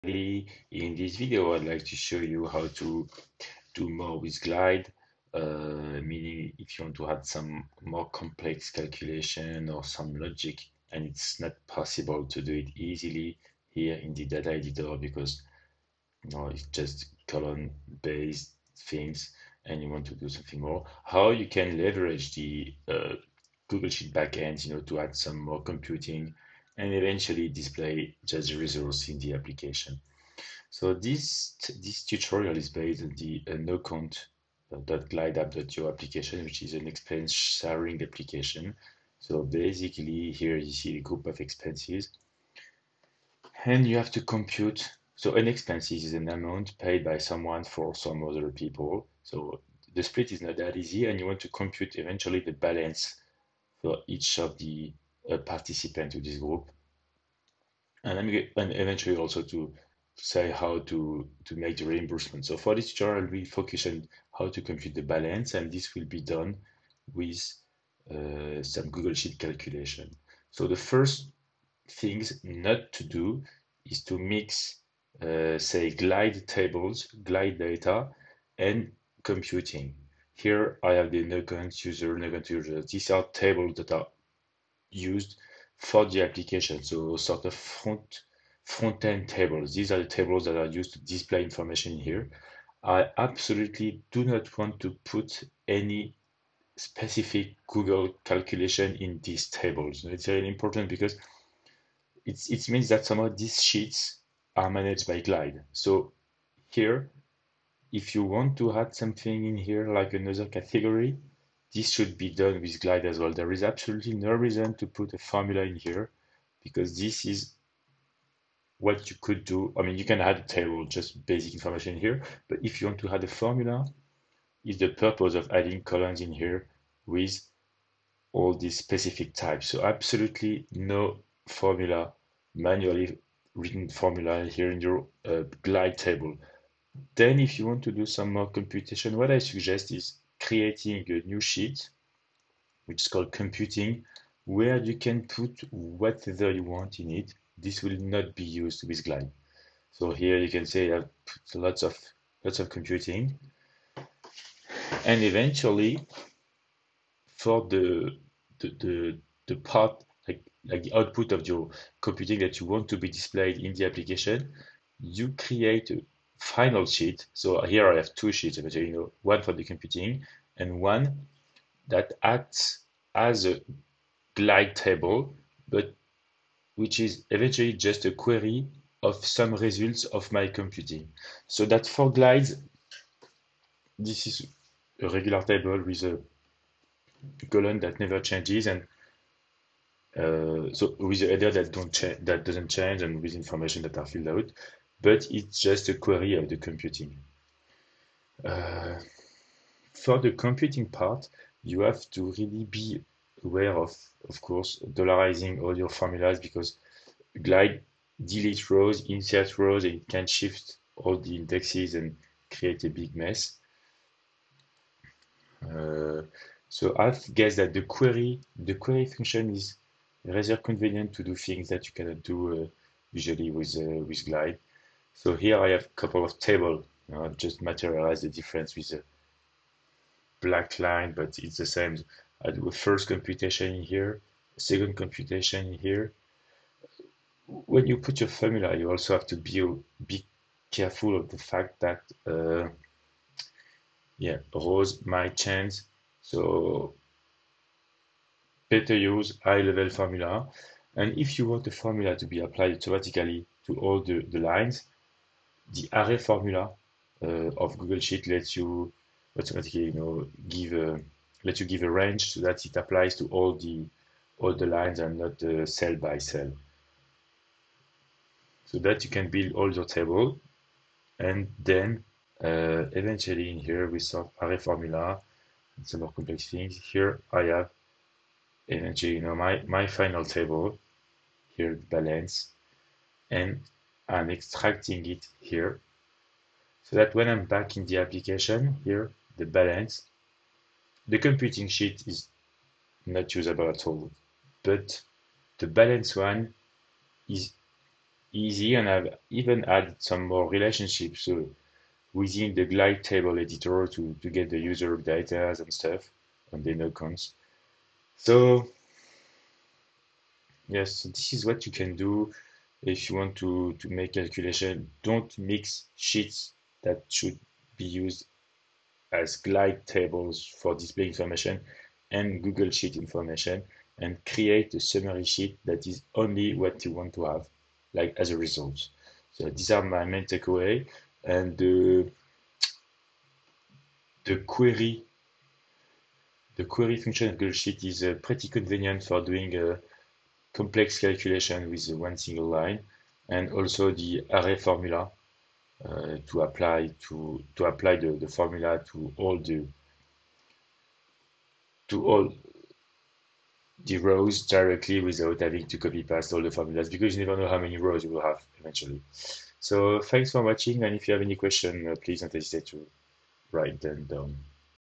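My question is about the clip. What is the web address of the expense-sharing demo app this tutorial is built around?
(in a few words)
nocount.glideapp.io.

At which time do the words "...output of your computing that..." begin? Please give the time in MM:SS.
02:40.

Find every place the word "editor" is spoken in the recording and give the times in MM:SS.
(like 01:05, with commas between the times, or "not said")
00:14, 05:03.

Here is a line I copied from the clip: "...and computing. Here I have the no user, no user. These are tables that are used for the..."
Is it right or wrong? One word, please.
right.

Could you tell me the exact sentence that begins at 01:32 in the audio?
I absolutely do not want to put any specific Google calculation in these tables.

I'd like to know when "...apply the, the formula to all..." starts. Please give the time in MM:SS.
05:47.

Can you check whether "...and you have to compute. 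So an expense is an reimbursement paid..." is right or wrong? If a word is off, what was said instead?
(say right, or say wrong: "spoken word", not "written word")
wrong: "amount", not "reimbursement".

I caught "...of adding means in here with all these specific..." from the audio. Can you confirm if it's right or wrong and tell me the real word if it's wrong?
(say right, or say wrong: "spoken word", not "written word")
wrong: "columns", not "means".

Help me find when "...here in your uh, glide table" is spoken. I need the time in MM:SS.
02:14.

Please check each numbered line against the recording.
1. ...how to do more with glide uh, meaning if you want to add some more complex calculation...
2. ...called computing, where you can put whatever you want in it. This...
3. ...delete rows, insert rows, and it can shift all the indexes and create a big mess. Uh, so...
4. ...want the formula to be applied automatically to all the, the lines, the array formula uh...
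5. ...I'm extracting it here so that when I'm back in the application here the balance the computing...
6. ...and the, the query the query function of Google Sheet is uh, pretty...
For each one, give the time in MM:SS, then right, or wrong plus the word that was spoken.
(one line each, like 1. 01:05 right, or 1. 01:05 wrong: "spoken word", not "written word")
1. 00:02 right
2. 02:23 right
3. 03:28 right
4. 04:11 right
5. 04:44 right
6. 05:31 right.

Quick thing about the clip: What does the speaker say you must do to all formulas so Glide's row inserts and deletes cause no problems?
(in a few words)
dollarizing.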